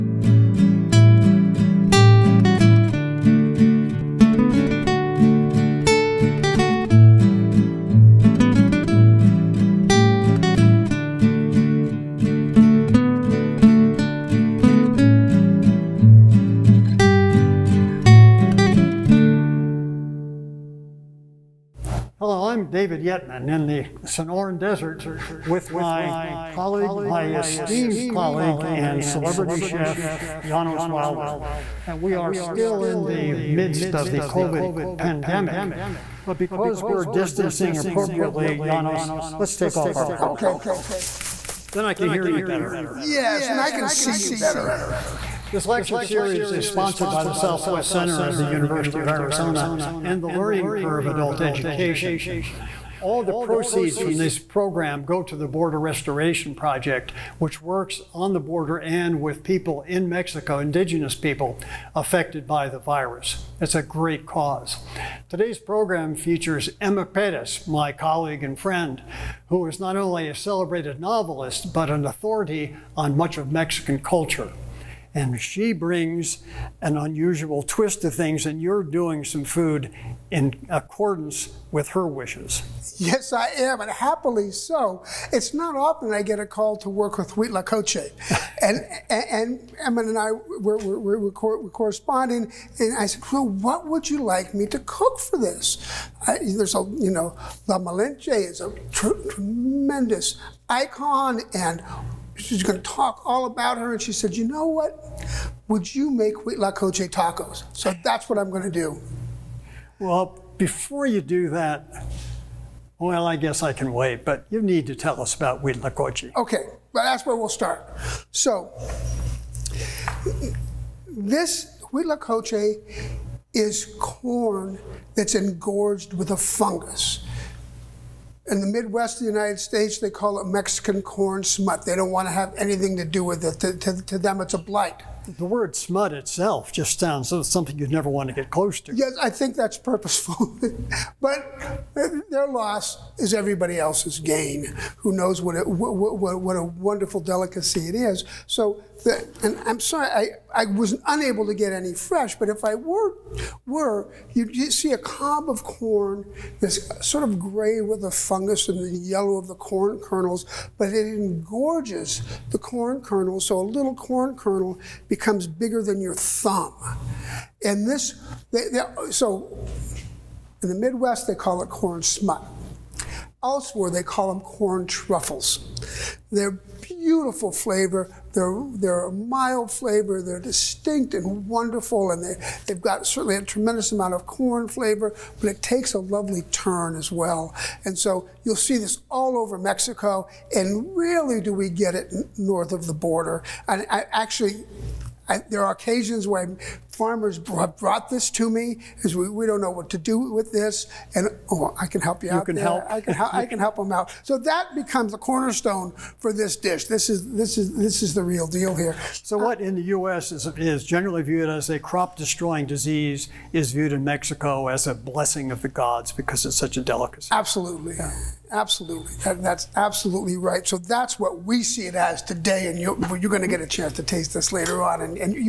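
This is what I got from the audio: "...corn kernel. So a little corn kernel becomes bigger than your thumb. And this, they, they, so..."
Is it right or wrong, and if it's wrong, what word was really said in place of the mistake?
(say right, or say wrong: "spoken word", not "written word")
right.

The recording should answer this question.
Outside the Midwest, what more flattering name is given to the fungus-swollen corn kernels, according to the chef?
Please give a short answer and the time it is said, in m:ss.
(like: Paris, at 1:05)
corn truffles, at 2:54.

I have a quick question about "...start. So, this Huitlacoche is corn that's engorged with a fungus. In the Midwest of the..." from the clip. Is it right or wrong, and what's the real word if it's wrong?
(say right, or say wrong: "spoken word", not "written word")
right.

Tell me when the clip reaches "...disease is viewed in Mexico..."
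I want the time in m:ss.
3:32.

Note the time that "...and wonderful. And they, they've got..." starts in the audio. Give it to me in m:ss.
3:01.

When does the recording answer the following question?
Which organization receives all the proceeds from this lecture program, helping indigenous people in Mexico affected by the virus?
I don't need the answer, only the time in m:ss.
0:55.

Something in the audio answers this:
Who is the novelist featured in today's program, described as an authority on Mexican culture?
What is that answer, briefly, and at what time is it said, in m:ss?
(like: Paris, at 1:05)
Emma Perez, at 1:06.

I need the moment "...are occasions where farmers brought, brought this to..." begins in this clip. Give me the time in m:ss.
3:15.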